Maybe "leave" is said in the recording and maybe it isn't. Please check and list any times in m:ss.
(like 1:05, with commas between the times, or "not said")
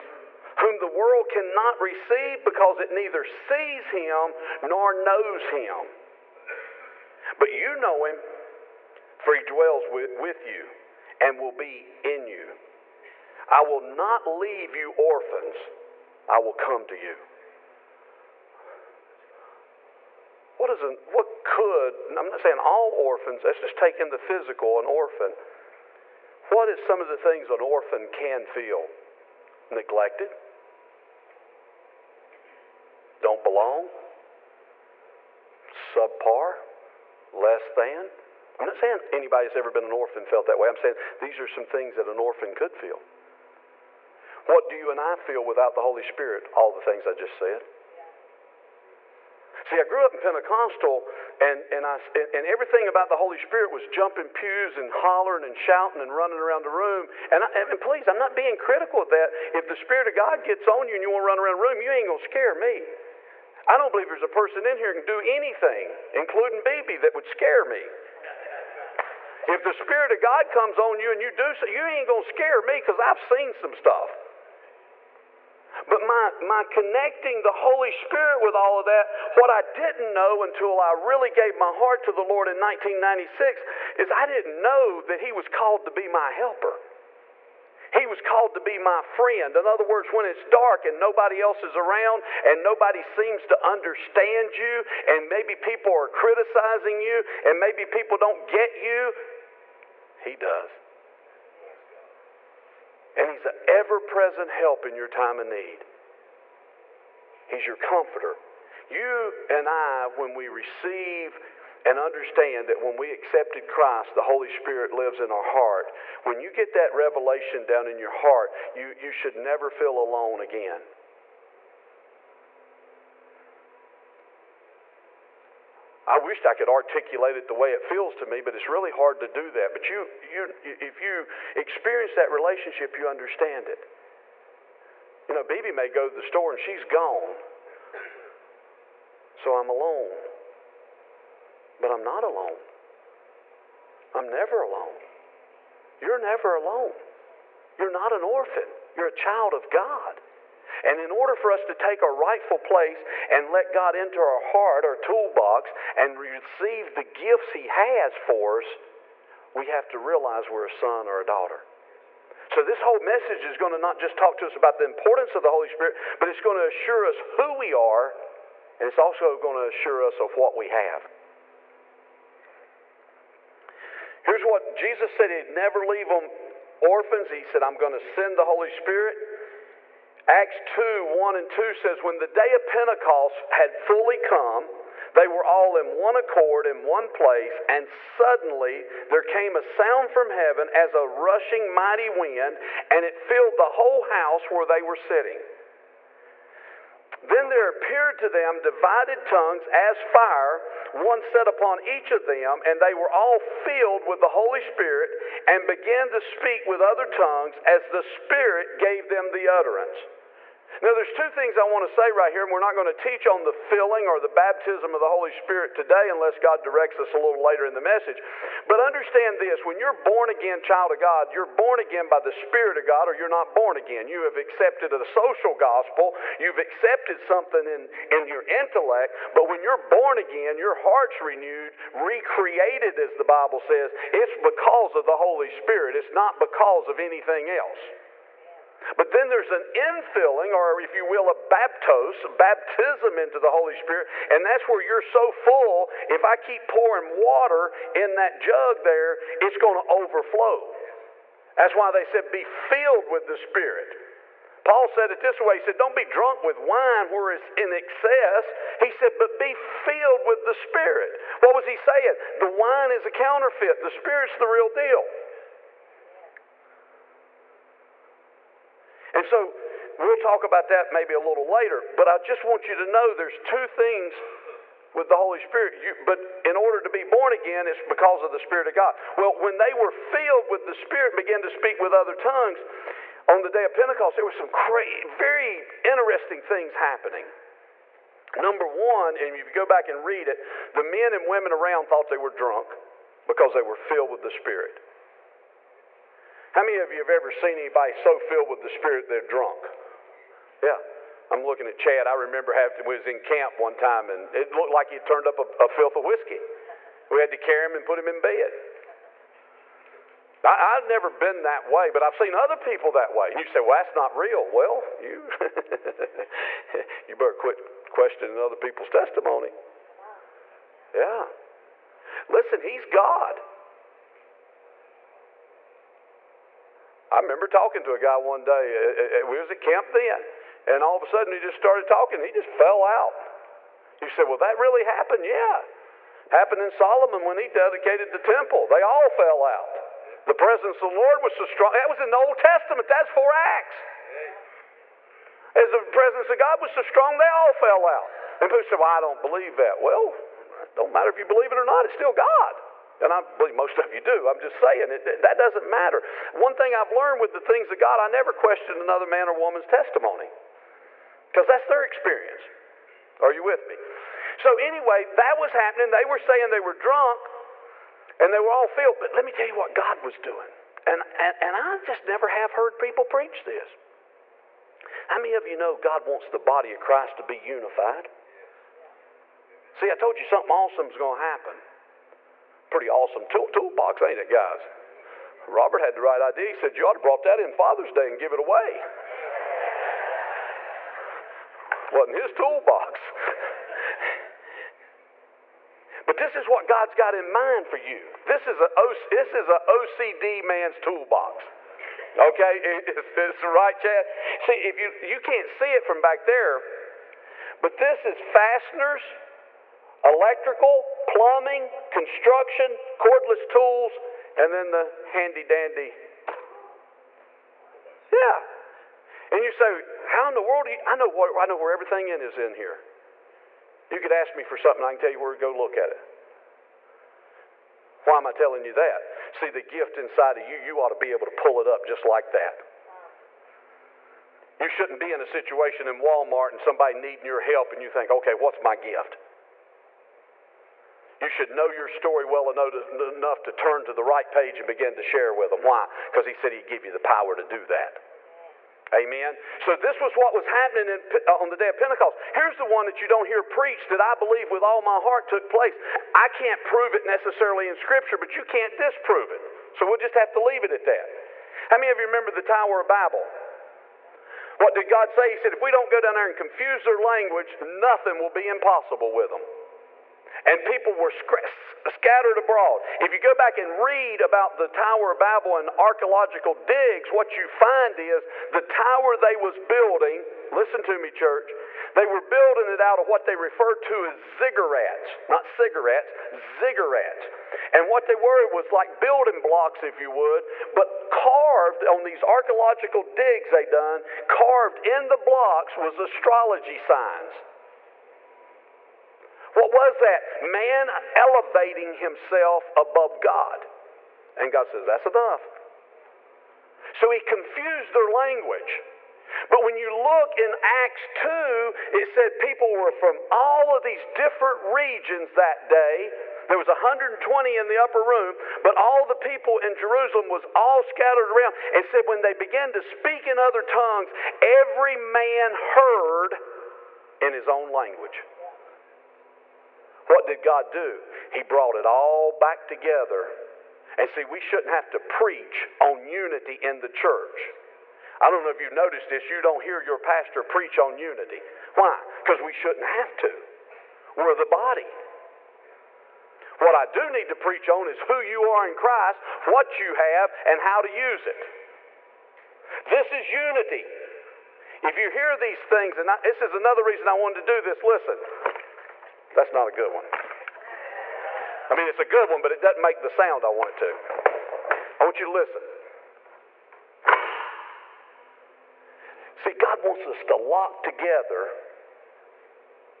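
0:14, 2:55, 7:40.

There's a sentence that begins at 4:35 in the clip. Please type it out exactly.
You, but in order to be born again, it's because of the Spirit of God.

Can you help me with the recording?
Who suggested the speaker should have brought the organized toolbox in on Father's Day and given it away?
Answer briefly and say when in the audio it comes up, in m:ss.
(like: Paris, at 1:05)
Robert, at 6:25.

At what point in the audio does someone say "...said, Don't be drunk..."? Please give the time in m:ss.
4:15.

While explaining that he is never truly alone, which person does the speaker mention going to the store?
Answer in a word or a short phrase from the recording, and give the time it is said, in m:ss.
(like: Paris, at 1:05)
Bibi, at 2:15.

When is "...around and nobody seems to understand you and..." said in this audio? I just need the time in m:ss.
1:31.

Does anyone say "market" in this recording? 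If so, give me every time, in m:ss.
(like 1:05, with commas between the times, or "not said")
not said.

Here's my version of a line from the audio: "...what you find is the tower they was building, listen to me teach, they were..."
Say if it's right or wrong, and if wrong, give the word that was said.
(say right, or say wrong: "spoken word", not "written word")
wrong: "church", not "teach".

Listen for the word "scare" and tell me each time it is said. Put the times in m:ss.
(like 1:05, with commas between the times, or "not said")
1:02, 1:07, 1:12.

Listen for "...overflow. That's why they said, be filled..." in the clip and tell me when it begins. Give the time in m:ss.
4:09.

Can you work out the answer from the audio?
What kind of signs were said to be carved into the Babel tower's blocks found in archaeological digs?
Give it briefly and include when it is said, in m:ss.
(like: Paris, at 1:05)
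astrology signs, at 8:15.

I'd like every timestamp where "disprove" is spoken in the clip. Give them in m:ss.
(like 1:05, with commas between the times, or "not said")
7:38.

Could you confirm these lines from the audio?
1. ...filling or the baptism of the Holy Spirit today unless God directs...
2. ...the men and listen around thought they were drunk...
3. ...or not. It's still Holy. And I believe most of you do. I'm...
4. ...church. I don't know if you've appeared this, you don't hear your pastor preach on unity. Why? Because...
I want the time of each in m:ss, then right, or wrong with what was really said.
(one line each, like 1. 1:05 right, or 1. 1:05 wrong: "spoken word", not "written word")
1. 3:33 right
2. 4:50 wrong: "women", not "listen"
3. 5:51 wrong: "God", not "Holy"
4. 8:56 wrong: "noticed", not "appeared".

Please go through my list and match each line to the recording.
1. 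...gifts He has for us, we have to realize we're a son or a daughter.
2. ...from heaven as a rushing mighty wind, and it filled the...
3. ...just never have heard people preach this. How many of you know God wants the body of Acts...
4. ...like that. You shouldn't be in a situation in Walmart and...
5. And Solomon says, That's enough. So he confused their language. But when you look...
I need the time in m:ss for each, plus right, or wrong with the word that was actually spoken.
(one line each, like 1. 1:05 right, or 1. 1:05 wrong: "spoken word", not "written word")
1. 2:37 right
2. 3:10 right
3. 6:11 wrong: "Christ", not "Acts"
4. 7:12 right
5. 8:24 wrong: "God", not "Solomon".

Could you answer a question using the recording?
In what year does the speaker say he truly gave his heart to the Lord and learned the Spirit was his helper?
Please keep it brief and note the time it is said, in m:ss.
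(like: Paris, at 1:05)
1996, at 1:22.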